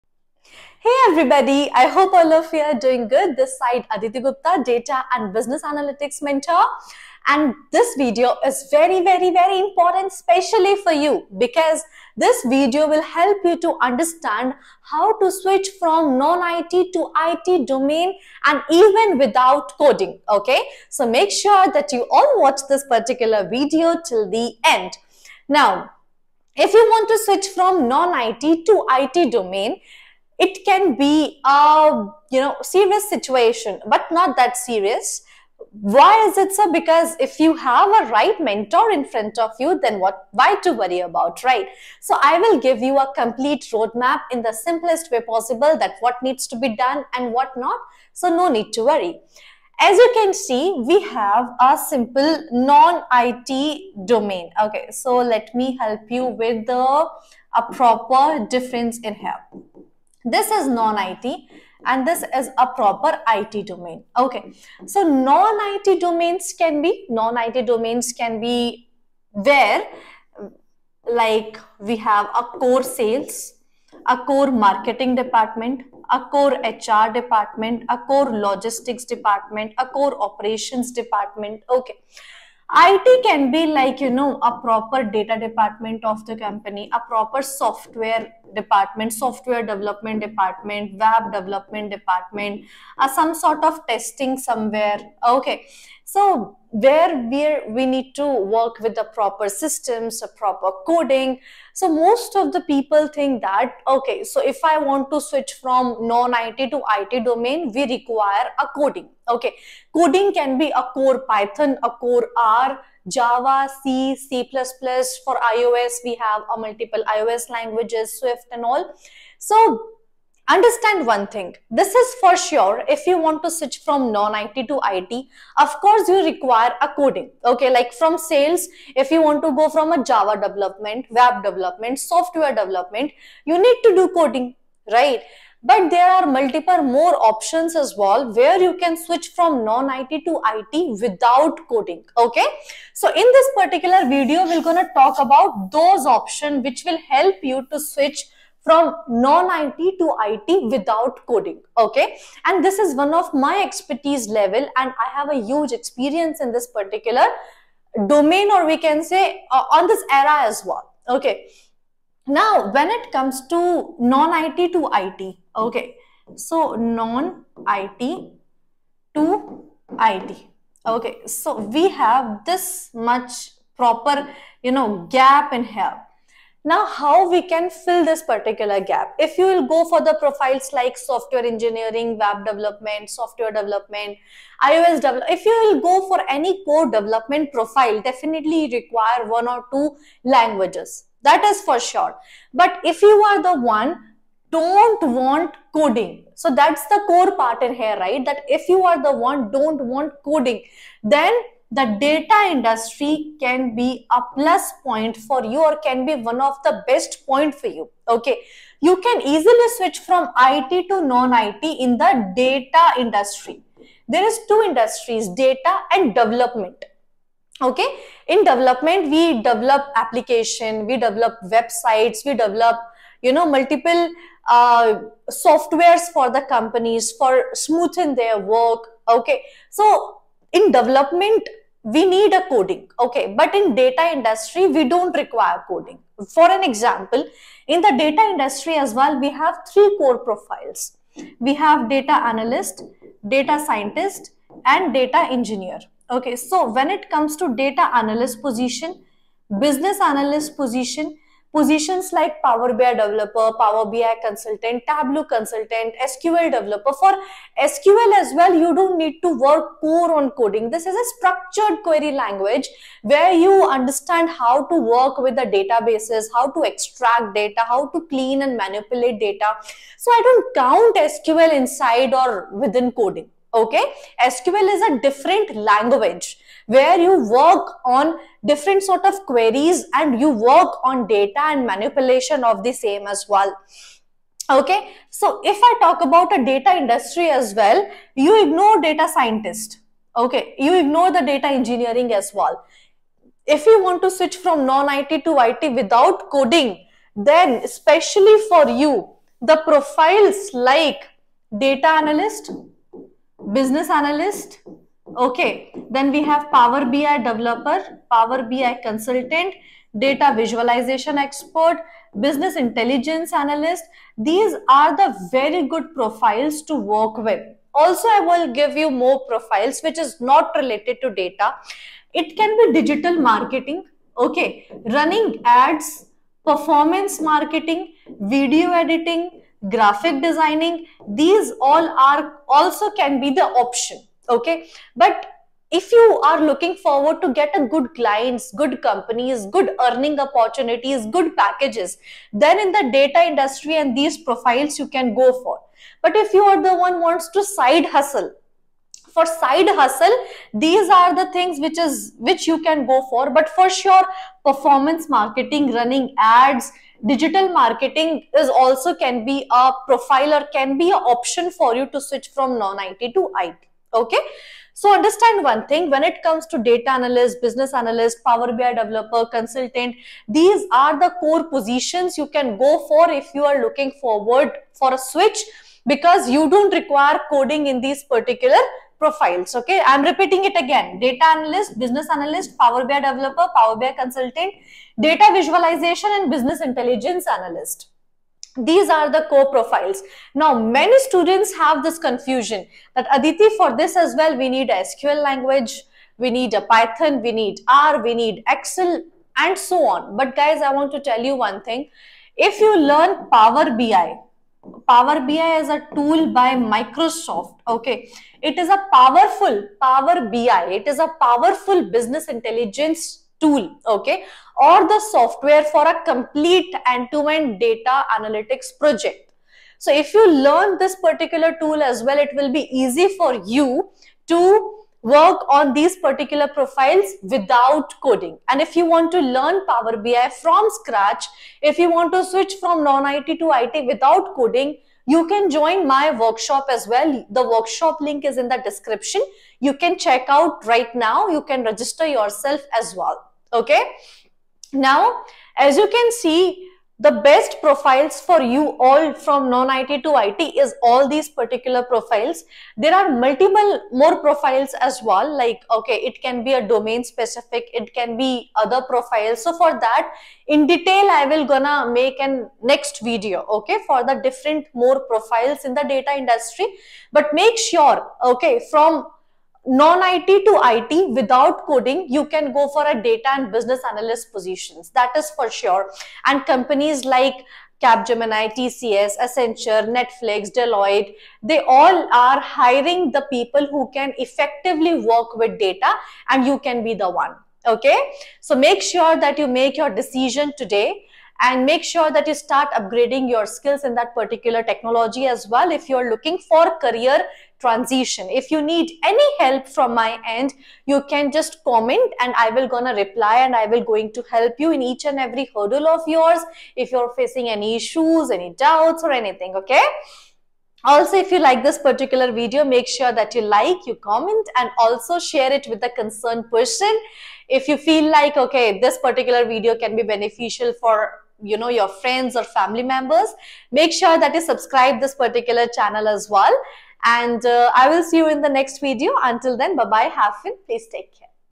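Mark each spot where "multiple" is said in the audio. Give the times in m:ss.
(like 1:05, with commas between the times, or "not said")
1:56, 2:16, 3:43, 7:33.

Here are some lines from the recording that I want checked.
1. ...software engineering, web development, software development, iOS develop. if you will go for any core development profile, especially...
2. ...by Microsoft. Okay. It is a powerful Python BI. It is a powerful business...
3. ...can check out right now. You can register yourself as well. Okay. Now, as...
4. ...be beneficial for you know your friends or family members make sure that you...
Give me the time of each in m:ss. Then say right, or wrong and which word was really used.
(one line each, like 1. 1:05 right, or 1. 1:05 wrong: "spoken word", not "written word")
1. 3:00 wrong: "definitely", not "especially"
2. 6:46 wrong: "Power", not "Python"
3. 7:19 right
4. 8:39 right.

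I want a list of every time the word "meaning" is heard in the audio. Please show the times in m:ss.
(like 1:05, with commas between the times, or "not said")
not said.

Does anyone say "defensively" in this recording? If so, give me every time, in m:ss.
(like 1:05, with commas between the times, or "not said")
not said.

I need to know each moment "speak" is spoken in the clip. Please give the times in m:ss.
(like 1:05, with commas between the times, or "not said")
not said.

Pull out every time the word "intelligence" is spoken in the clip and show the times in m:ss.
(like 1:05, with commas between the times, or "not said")
5:12, 6:26, 6:52.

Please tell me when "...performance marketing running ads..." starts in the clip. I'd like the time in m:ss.
5:54.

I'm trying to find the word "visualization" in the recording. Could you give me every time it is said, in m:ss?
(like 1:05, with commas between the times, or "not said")
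5:10, 6:25.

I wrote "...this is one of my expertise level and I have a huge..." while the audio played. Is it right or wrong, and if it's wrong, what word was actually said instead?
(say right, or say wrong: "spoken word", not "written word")
right.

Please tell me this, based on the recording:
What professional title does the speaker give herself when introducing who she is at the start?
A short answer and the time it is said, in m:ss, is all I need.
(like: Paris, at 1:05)
Data and Business Analytics Mentor, at 0:04.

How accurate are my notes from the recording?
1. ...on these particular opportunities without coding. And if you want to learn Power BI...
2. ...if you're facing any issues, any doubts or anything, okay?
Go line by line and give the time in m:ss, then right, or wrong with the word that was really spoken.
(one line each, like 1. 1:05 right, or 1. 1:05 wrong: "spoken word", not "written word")
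1. 7:05 wrong: "profiles", not "opportunities"
2. 8:26 right.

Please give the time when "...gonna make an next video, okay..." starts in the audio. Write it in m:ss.
7:41.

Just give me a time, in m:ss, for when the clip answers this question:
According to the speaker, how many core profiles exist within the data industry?
3:59.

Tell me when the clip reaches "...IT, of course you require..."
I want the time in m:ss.
2:04.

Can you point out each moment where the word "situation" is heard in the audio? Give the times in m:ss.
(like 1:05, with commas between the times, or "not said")
0:33.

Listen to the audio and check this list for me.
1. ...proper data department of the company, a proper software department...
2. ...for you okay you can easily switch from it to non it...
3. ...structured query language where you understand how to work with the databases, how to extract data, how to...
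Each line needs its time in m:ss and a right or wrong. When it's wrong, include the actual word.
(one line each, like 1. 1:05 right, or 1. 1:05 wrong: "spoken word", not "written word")
1. 1:24 right
2. 3:27 right
3. 4:21 right.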